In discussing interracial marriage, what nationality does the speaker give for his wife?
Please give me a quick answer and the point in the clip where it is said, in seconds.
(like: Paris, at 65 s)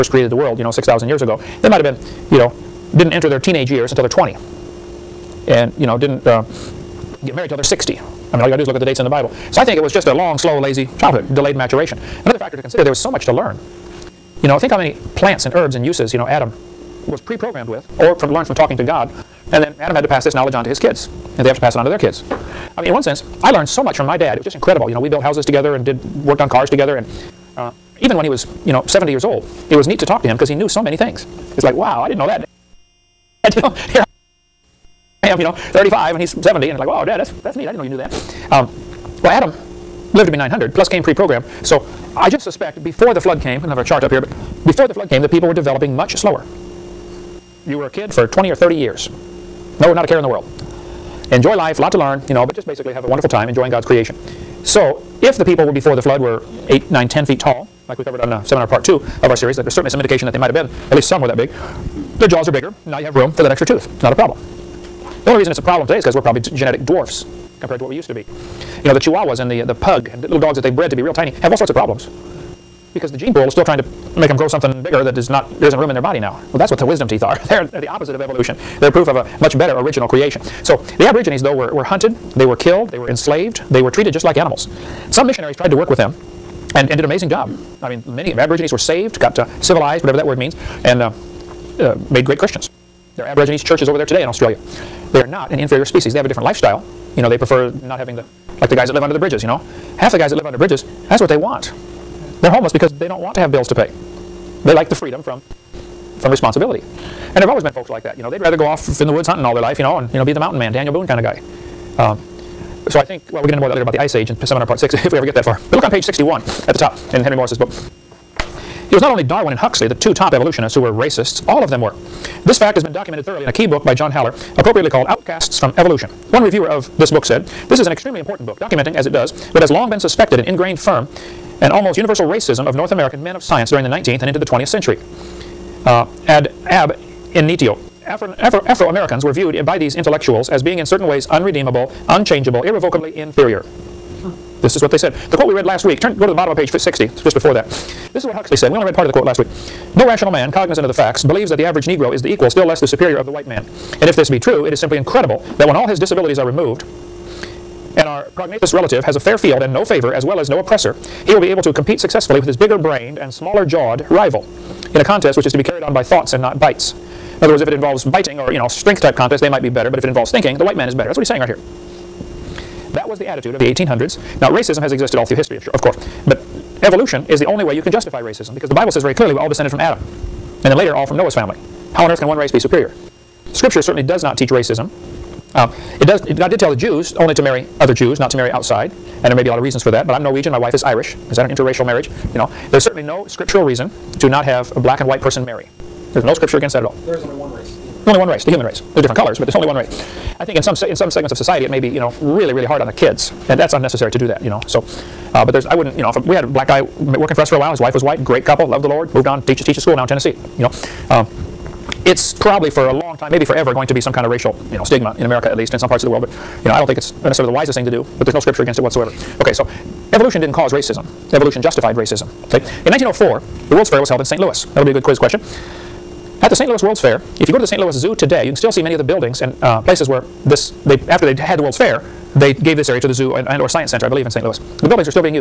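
Irish, at 190 s.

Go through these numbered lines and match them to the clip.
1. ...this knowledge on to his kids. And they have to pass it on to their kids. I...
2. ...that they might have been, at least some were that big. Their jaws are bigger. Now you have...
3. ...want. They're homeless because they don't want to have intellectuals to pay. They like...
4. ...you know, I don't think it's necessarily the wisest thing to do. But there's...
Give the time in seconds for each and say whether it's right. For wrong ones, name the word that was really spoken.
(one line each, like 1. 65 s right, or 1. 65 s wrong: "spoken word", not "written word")
1. 20 s right
2. 60 s right
3. 101 s wrong: "bills", not "intellectuals"
4. 216 s right.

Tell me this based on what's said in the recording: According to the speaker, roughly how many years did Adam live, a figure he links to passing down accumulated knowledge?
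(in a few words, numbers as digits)
900.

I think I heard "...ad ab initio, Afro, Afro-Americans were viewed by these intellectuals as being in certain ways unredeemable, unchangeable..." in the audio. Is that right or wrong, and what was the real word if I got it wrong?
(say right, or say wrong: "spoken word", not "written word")
right.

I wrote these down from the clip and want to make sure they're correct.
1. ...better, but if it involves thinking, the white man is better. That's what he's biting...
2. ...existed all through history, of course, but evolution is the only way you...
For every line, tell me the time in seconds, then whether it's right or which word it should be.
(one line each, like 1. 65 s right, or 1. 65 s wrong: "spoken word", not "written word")
1. 169 s wrong: "saying", not "biting"
2. 174 s right.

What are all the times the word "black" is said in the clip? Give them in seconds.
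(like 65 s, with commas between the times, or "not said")
194 s, 206 s.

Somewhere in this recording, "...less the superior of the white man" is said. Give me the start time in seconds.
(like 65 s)
152 s.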